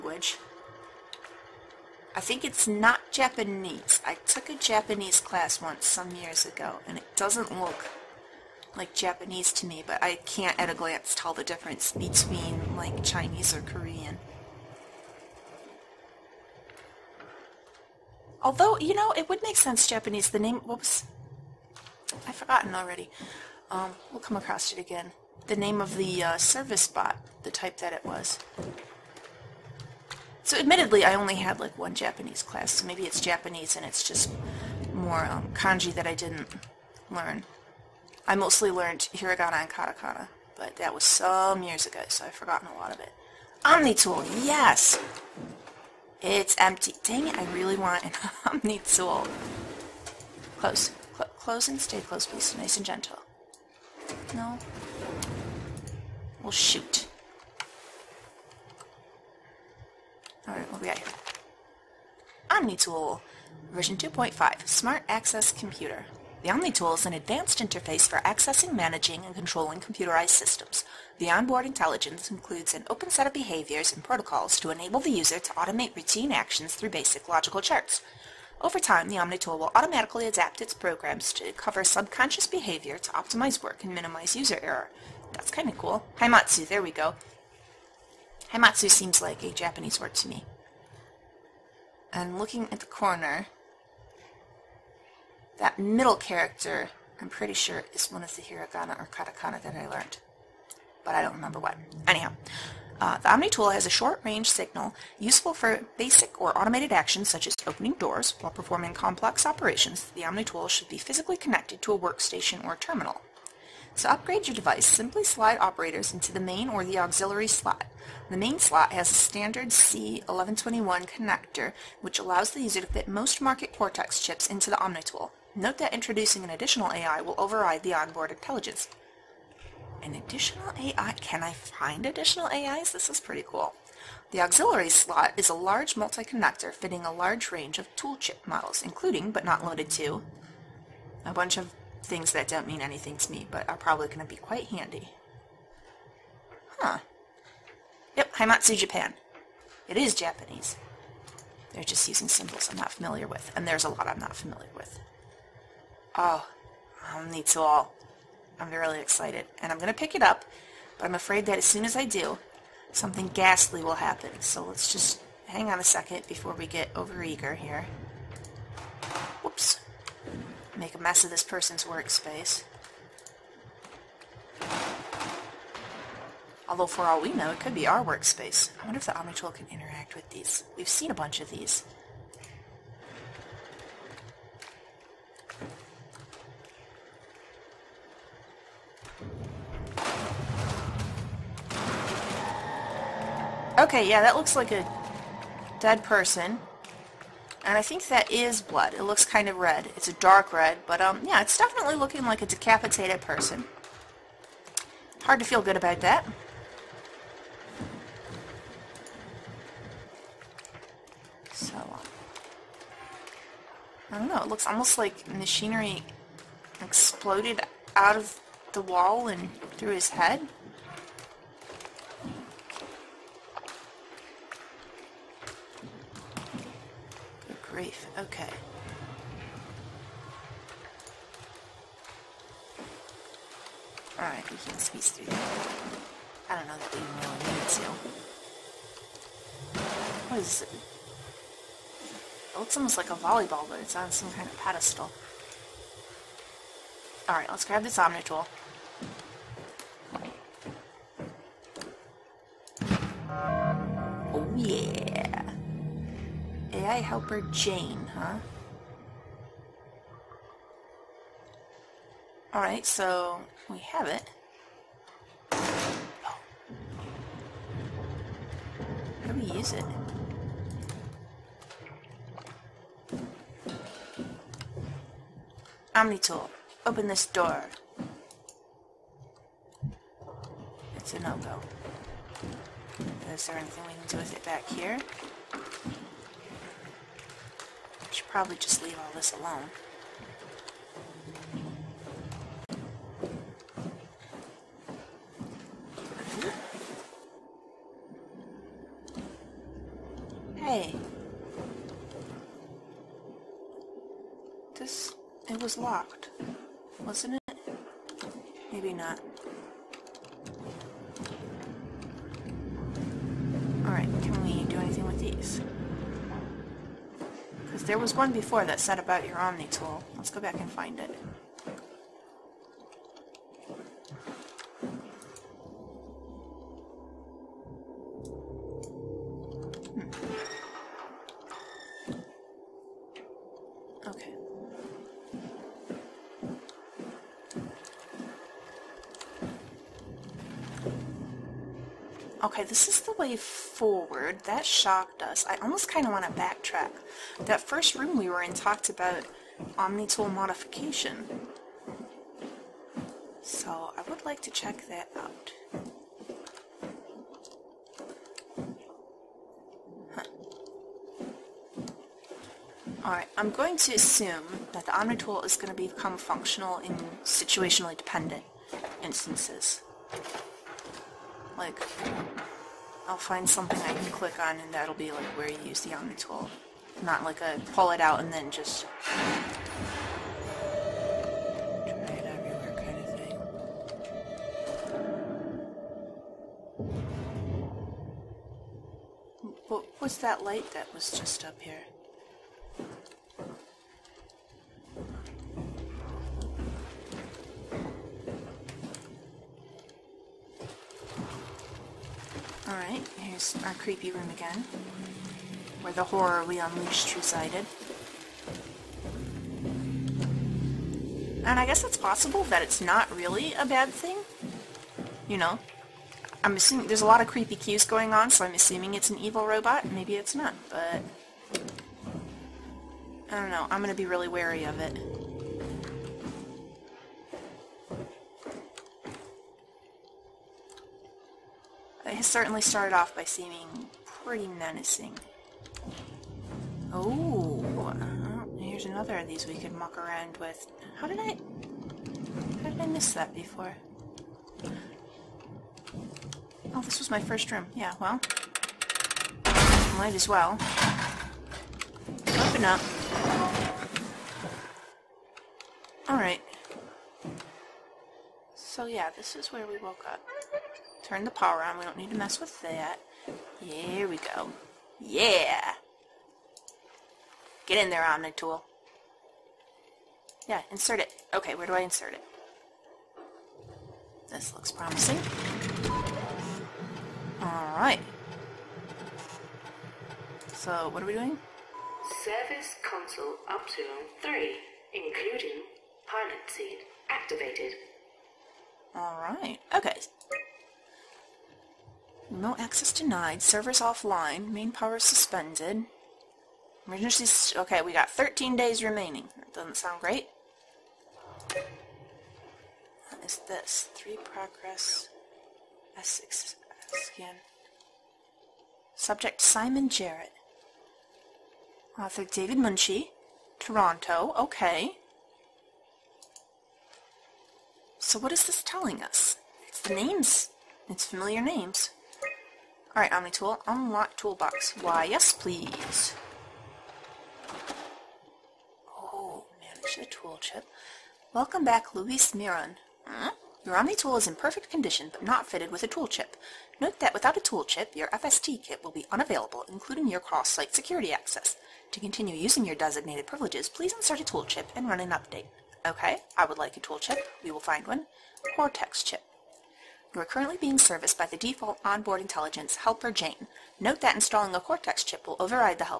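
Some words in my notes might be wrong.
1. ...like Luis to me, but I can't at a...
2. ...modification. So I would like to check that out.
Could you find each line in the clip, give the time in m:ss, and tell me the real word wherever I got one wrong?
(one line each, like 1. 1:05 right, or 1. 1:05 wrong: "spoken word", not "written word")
1. 0:08 wrong: "Japanese", not "Luis"
2. 5:50 right.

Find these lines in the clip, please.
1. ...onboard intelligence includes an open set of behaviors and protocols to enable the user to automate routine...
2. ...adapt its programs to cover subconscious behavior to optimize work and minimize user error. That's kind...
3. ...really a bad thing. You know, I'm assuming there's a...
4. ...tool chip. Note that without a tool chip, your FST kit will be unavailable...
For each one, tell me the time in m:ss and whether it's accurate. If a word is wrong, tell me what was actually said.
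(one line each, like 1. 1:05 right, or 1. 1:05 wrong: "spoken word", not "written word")
1. 1:11 right
2. 1:20 right
3. 6:53 right
4. 8:55 right.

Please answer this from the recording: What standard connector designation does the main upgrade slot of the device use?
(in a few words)
C1121.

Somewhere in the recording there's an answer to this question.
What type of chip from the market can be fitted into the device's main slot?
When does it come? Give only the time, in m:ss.
2:03.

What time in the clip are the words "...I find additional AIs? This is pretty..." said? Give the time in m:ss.
2:11.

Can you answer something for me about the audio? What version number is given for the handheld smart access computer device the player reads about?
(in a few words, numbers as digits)
2.5.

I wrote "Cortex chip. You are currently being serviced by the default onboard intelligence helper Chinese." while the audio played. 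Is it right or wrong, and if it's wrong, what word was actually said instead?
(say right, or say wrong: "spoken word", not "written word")
wrong: "Jane", not "Chinese".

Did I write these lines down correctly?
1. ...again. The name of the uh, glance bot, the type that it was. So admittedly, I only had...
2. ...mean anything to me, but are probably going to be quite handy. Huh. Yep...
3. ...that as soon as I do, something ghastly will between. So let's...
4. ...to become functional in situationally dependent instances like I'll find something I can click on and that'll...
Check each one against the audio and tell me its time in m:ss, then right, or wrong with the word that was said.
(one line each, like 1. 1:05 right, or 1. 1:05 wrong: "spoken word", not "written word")
1. 0:24 wrong: "service", not "glance"
2. 2:22 right
3. 2:41 wrong: "happen", not "between"
4. 6:05 right.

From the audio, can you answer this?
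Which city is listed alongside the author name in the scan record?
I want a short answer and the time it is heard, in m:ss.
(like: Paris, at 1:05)
Toronto, at 8:33.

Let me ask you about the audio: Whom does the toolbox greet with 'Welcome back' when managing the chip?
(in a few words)
Luis Miron.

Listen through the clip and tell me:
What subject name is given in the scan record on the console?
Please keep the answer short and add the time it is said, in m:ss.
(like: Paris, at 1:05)
Simon Jarrett, at 8:29.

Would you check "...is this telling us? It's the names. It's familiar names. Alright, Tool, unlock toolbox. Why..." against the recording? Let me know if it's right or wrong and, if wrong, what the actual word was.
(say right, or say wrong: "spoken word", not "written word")
right.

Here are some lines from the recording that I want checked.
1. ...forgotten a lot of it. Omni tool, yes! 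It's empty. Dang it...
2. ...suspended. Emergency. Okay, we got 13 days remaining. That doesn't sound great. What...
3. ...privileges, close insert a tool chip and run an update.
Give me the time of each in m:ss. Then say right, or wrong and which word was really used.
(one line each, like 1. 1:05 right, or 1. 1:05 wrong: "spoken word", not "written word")
1. 0:42 right
2. 8:14 right
3. 9:03 wrong: "please", not "close".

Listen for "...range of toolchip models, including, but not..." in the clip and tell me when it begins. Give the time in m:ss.
2:17.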